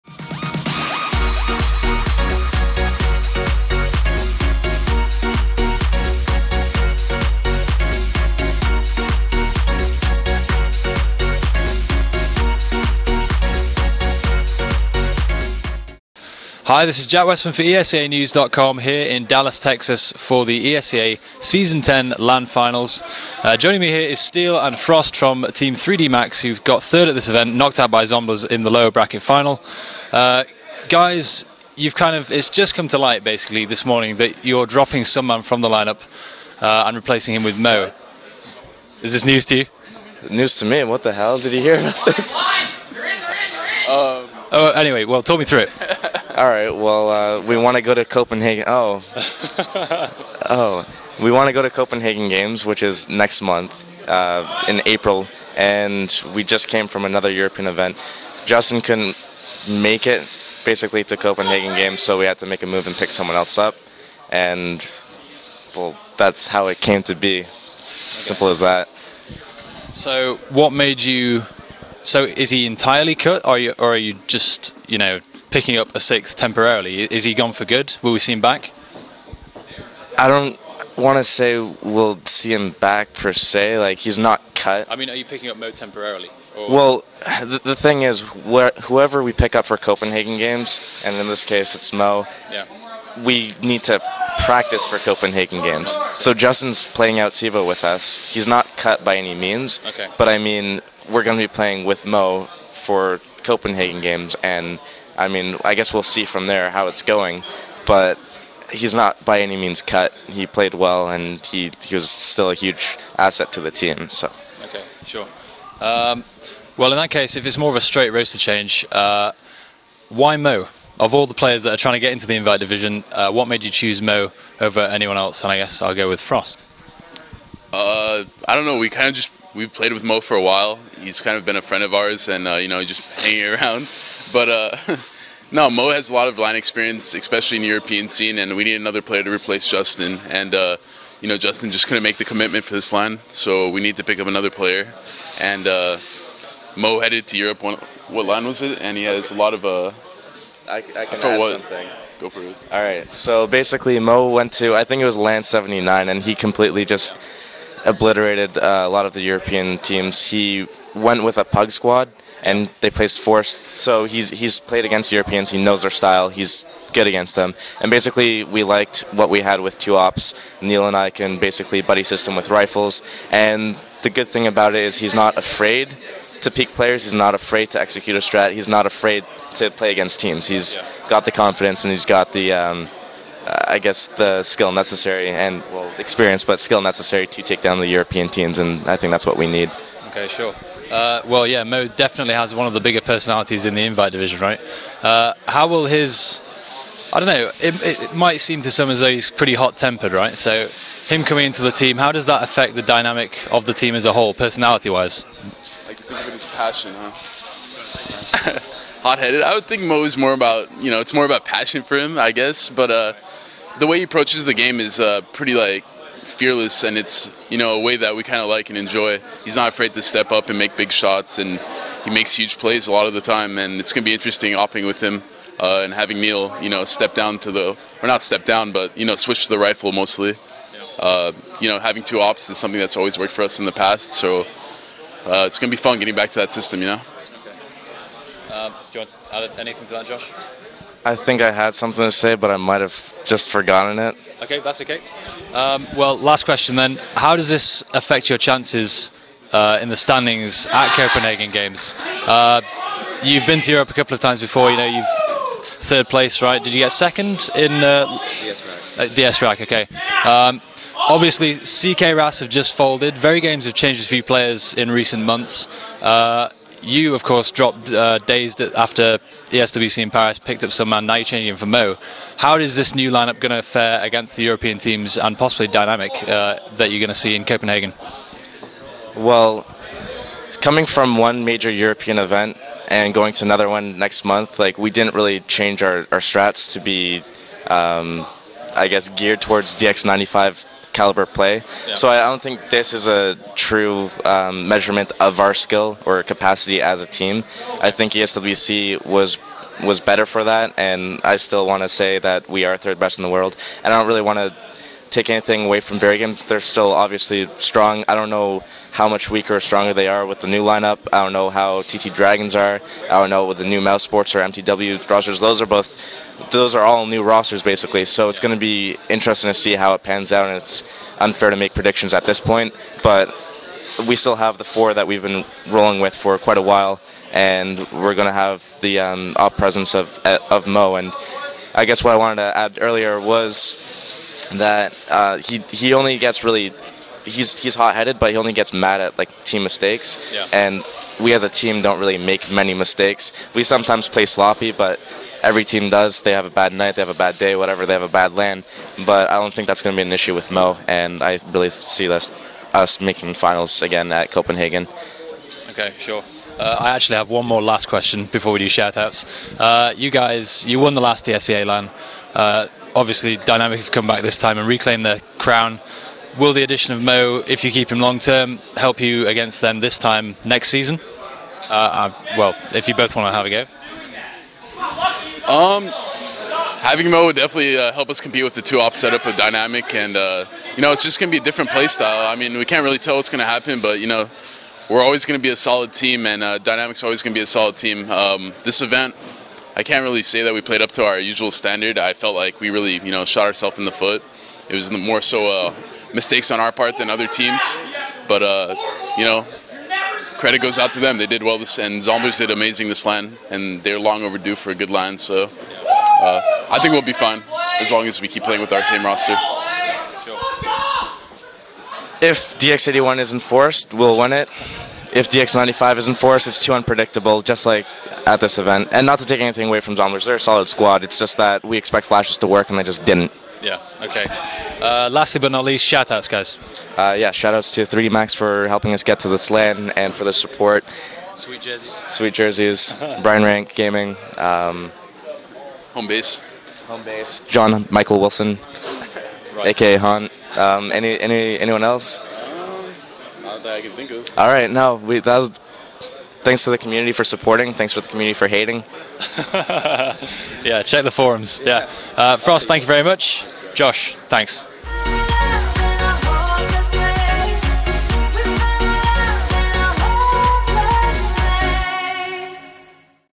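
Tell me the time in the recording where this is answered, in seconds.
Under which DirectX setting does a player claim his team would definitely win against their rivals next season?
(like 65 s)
412 s.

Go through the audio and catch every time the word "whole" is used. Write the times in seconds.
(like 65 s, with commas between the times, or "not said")
204 s.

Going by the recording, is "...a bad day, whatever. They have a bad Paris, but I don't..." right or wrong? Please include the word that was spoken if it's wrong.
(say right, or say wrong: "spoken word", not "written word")
wrong: "LAN", not "Paris".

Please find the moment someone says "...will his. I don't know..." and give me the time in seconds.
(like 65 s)
195 s.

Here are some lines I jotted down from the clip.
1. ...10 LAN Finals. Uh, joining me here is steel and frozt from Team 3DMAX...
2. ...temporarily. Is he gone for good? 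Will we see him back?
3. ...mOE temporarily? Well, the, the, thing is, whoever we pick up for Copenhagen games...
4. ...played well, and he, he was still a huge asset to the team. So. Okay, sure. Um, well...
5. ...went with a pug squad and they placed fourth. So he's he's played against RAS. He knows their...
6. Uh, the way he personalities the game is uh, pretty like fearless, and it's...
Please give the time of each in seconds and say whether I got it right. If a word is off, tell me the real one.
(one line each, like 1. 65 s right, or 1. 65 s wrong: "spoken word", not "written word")
1. 21 s right
2. 76 s right
3. 85 s right
4. 110 s right
5. 160 s wrong: "Europeans", not "RAS"
6. 212 s wrong: "approaches", not "personalities".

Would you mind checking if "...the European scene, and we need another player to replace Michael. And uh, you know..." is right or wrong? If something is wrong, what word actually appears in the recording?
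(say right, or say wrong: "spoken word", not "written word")
wrong: "Justin", not "Michael".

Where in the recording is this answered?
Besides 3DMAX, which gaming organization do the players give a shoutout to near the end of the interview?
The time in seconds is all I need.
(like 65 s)
433 s.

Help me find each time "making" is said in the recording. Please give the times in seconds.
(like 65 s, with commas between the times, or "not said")
353 s.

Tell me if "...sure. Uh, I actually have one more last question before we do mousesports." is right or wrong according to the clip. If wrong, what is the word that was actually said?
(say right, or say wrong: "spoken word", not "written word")
wrong: "shoutouts", not "mousesports".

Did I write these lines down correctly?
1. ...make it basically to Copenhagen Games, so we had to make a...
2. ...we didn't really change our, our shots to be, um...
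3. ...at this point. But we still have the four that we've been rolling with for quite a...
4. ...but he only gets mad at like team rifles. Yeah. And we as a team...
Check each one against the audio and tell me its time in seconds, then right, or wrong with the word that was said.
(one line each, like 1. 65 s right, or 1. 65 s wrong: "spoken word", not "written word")
1. 59 s right
2. 284 s wrong: "strats", not "shots"
3. 322 s right
4. 338 s wrong: "mistakes", not "rifles".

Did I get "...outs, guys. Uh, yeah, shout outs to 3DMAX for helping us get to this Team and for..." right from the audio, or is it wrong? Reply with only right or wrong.
wrong.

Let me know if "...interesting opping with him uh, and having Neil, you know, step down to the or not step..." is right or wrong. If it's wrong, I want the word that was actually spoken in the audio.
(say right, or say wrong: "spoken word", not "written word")
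right.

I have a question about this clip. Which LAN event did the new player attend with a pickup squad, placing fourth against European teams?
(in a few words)
LAN 79.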